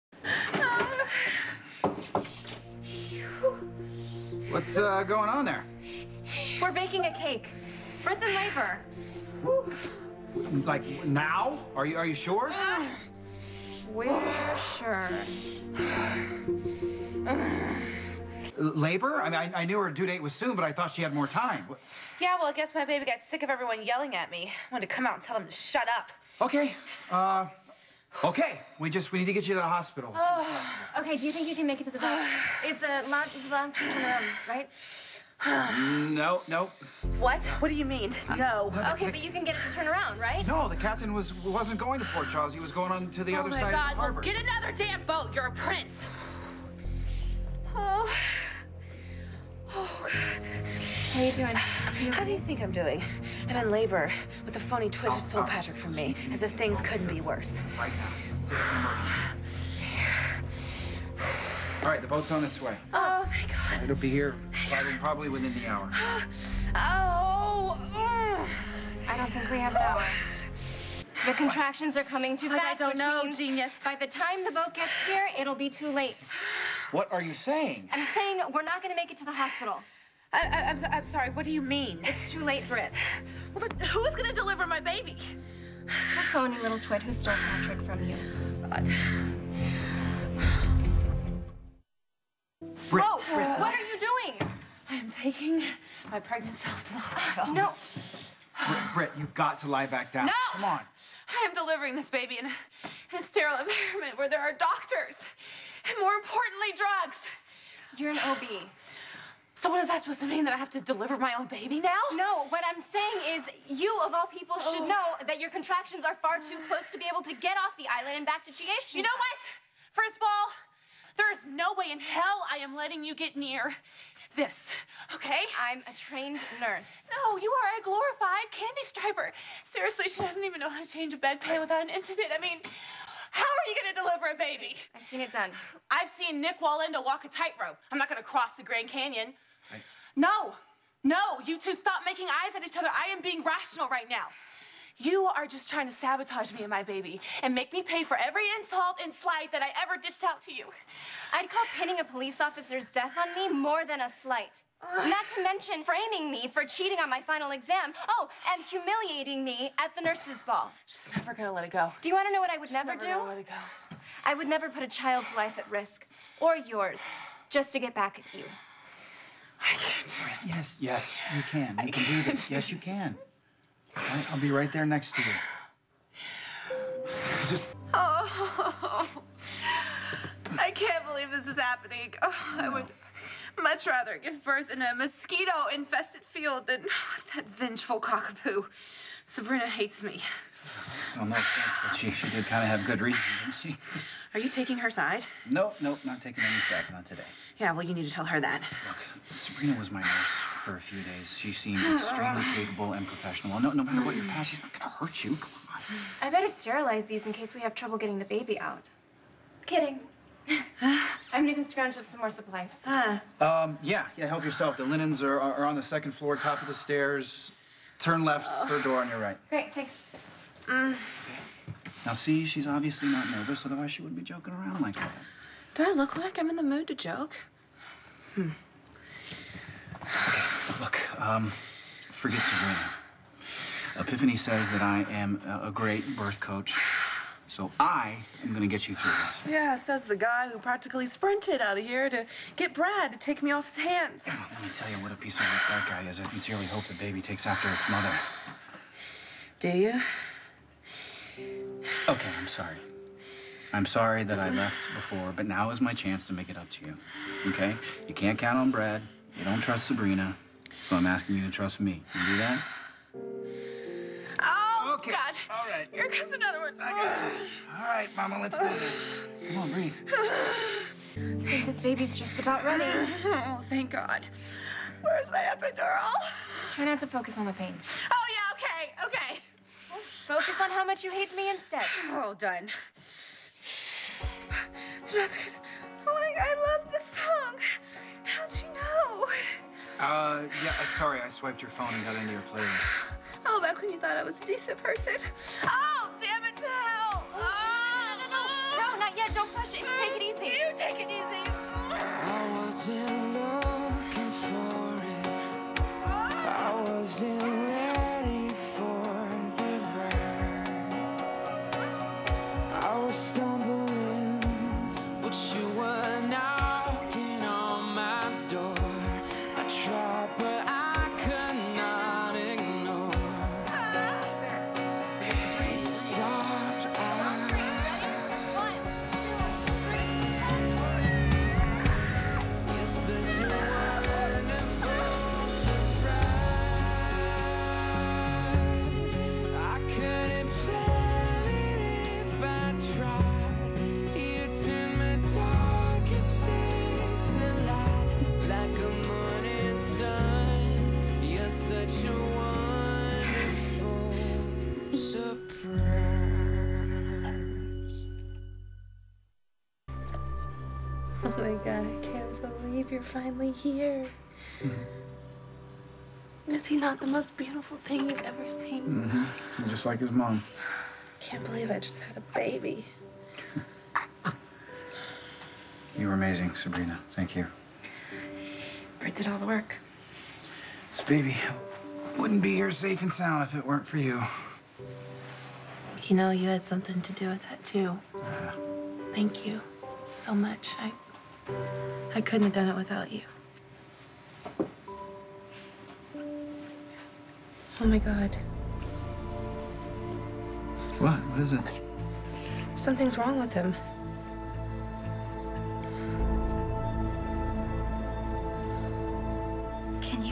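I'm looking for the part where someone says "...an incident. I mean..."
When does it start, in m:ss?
2:11.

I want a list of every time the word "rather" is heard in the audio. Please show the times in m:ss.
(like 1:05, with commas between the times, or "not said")
3:03.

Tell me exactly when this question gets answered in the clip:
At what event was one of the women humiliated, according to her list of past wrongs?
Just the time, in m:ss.
2:40.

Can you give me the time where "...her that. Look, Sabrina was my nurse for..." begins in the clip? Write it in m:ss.
3:18.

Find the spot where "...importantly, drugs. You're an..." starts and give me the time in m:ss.
1:46.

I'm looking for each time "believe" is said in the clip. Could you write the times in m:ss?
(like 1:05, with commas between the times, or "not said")
3:01, 6:02, 6:11.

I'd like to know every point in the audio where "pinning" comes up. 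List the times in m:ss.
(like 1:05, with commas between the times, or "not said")
2:31.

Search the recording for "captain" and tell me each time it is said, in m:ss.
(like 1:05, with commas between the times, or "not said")
0:40.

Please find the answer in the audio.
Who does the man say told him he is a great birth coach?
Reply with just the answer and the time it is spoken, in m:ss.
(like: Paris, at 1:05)
Epiphany, at 3:53.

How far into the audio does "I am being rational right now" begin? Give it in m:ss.
2:22.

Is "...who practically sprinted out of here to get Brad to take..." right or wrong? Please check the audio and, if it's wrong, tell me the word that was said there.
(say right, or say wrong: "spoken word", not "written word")
right.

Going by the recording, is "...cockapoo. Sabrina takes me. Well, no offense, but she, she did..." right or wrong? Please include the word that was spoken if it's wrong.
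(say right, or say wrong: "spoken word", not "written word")
wrong: "hates", not "takes".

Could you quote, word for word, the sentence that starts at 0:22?
Yeah, well, I guess my baby got sick of everyone yelling at me.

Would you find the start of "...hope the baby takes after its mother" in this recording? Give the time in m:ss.
4:06.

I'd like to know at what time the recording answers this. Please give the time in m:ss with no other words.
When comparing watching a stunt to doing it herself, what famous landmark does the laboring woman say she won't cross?
2:18.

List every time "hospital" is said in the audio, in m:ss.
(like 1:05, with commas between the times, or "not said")
0:29, 1:19, 1:36.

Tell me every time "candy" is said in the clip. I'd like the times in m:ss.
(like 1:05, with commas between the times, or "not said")
2:08.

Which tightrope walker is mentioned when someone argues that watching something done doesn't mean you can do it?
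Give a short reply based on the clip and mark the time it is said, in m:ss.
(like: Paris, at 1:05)
Nik Wallenda, at 2:16.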